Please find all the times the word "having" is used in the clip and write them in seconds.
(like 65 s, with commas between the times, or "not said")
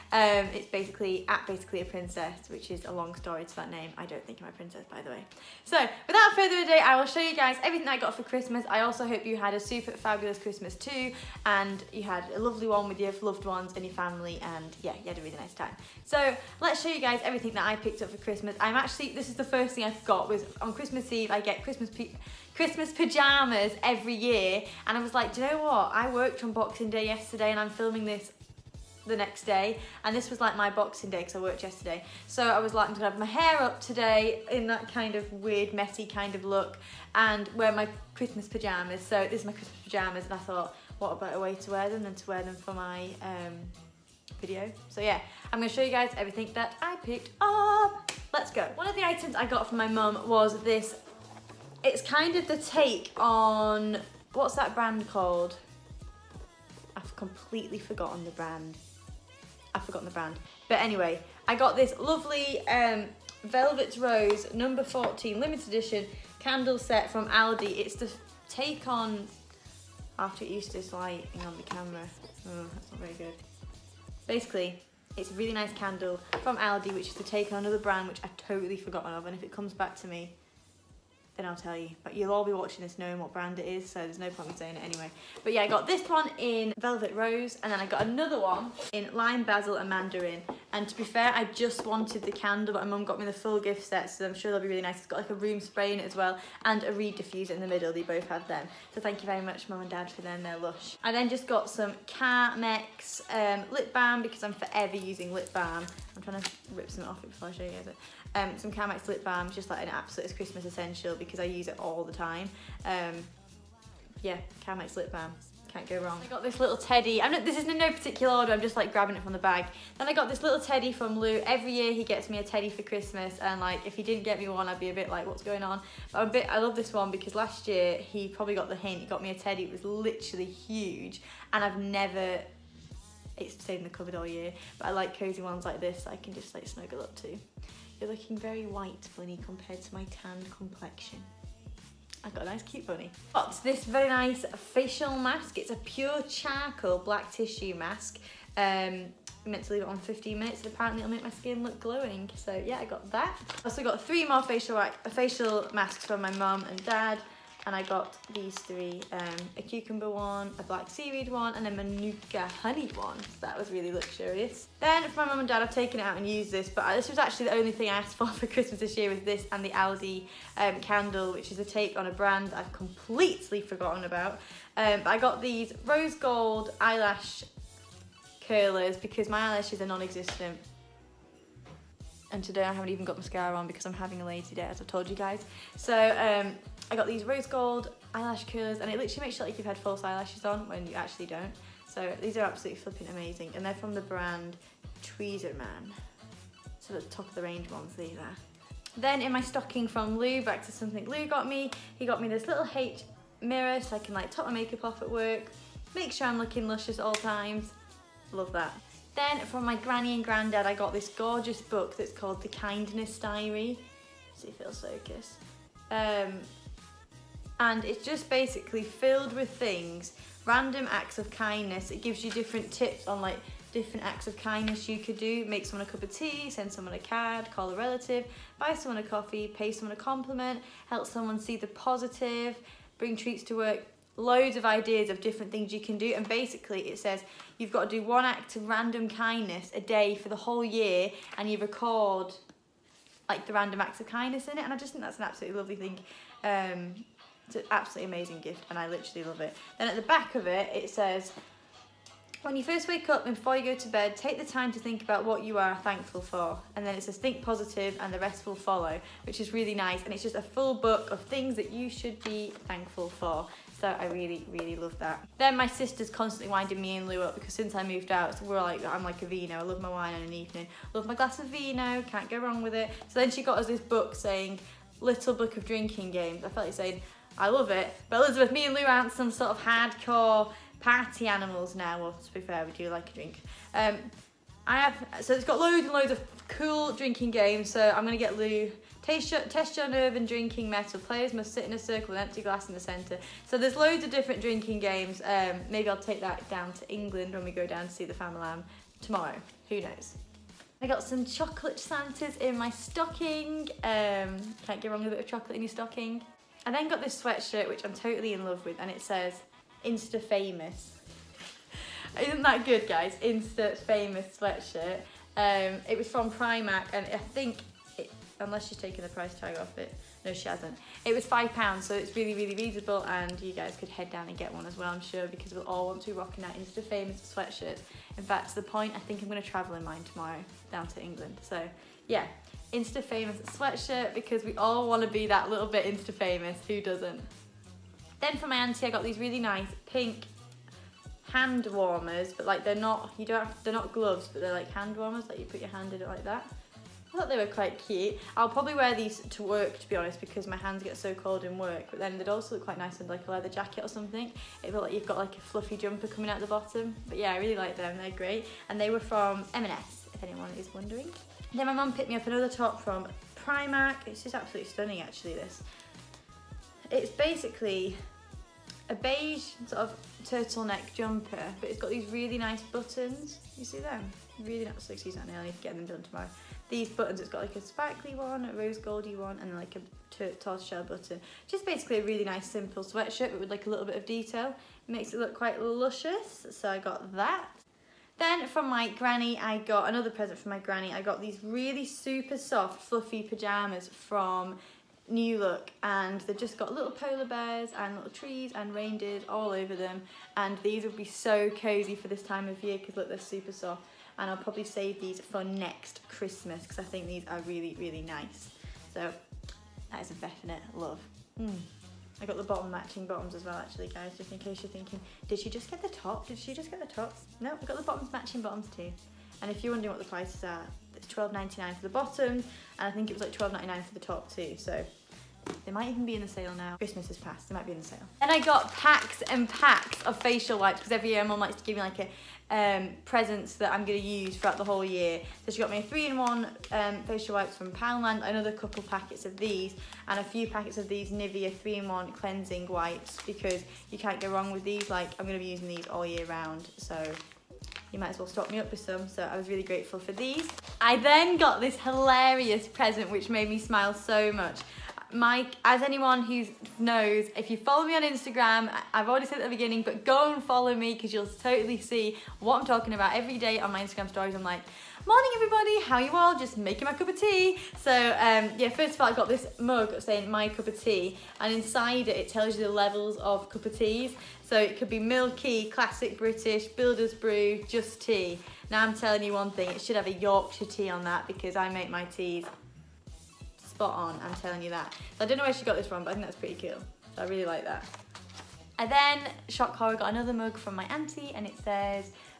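183 s.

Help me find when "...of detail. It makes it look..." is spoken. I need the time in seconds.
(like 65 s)
383 s.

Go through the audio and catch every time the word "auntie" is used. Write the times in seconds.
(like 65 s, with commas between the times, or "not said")
338 s, 490 s.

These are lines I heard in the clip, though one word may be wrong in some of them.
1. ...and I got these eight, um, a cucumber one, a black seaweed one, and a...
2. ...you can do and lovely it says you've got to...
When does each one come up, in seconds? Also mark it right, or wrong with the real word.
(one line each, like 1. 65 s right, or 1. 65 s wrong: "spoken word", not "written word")
1. 157 s wrong: "three", not "eight"
2. 235 s wrong: "basically", not "lovely".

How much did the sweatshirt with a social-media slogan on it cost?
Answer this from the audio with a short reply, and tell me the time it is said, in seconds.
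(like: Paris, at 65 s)
5 pounds, at 321 s.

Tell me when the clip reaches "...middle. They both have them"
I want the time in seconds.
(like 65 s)
97 s.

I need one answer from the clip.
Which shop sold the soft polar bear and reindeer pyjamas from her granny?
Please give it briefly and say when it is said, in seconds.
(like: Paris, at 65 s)
New Look, at 395 s.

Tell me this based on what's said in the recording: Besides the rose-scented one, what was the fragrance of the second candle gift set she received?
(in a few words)
Lime Basil and Mandarin.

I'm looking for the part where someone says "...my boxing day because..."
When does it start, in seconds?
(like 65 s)
30 s.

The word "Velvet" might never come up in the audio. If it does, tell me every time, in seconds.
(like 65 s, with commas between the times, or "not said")
63 s, 86 s.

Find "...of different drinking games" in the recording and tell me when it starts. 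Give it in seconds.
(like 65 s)
294 s.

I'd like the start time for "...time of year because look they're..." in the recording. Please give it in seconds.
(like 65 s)
402 s.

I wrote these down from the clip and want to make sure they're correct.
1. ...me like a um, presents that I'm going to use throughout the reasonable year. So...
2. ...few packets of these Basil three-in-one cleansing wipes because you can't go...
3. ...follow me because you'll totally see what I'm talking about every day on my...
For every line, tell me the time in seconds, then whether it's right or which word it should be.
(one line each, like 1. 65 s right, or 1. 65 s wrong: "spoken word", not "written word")
1. 431 s wrong: "whole", not "reasonable"
2. 440 s wrong: "Nivea", not "Basil"
3. 460 s right.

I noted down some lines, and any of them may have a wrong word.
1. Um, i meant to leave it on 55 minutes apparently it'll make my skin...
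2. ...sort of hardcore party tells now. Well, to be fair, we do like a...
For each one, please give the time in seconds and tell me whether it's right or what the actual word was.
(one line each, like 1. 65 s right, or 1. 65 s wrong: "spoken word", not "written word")
1. 148 s wrong: "15", not "55"
2. 279 s wrong: "animals", not "tells".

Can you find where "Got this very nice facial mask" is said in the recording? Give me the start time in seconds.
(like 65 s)
143 s.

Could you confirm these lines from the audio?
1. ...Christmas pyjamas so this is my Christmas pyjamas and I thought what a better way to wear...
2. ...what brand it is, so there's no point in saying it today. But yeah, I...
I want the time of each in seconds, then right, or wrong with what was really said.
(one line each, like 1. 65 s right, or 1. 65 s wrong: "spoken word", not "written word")
1. 38 s right
2. 83 s wrong: "anyway", not "today".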